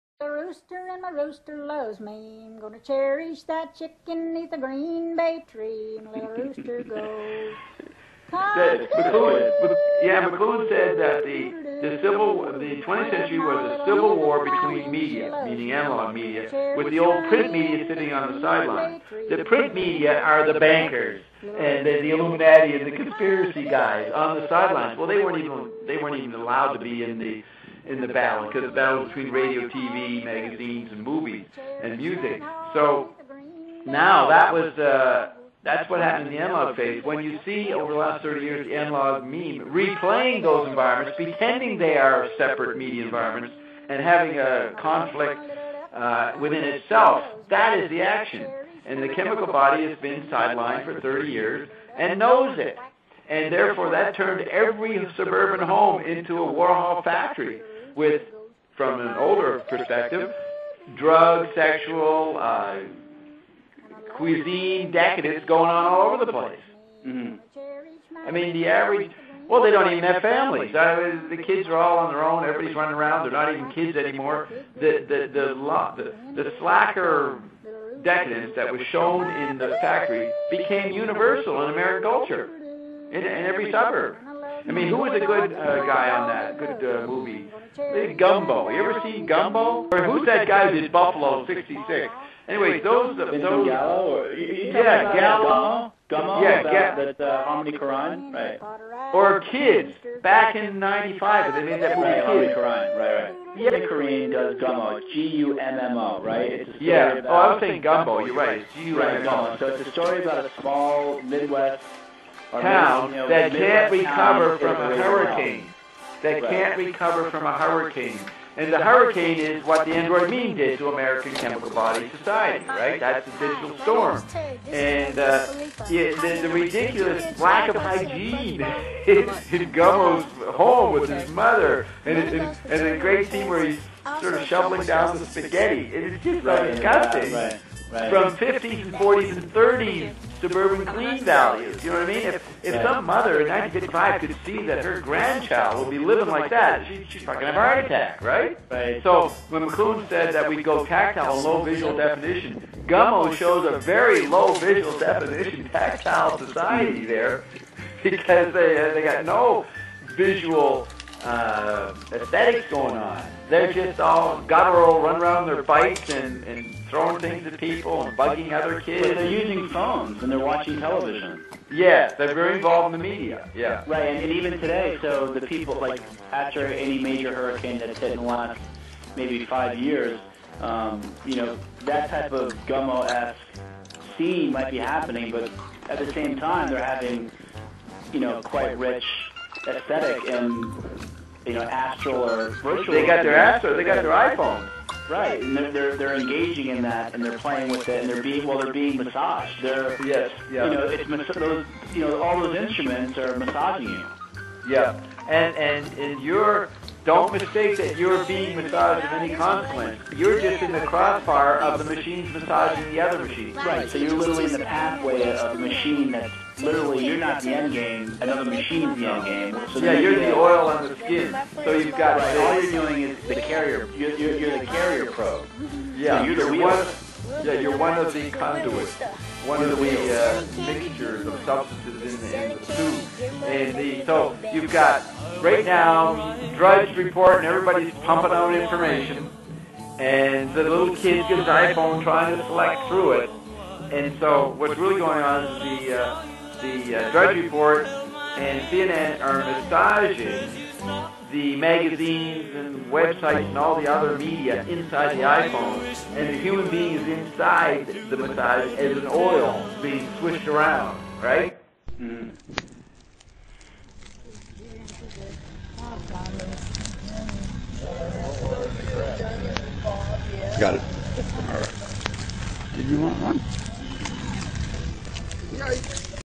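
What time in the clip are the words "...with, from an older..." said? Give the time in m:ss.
0:57.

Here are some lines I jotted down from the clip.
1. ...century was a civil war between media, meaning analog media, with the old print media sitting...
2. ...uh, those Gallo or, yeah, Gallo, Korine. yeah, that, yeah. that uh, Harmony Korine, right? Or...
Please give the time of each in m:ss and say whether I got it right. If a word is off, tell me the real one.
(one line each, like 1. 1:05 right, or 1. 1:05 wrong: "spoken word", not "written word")
1. 0:13 right
2. 1:33 wrong: "Gumbo", not "Korine".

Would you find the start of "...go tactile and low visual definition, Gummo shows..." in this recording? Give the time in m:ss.
2:30.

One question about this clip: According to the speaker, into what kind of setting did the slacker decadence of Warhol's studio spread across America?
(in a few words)
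every suburb.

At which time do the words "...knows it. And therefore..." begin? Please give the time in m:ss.
0:52.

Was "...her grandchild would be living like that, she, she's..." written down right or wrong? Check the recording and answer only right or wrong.
right.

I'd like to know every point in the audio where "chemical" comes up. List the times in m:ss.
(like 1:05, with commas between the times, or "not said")
0:49, 2:01.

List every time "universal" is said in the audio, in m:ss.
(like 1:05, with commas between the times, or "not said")
1:20.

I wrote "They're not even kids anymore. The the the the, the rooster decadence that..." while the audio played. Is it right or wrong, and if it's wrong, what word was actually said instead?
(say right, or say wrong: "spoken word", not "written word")
wrong: "slacker", not "rooster".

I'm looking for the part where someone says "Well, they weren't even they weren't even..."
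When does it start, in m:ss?
0:24.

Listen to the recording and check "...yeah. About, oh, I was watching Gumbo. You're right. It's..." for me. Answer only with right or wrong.
wrong.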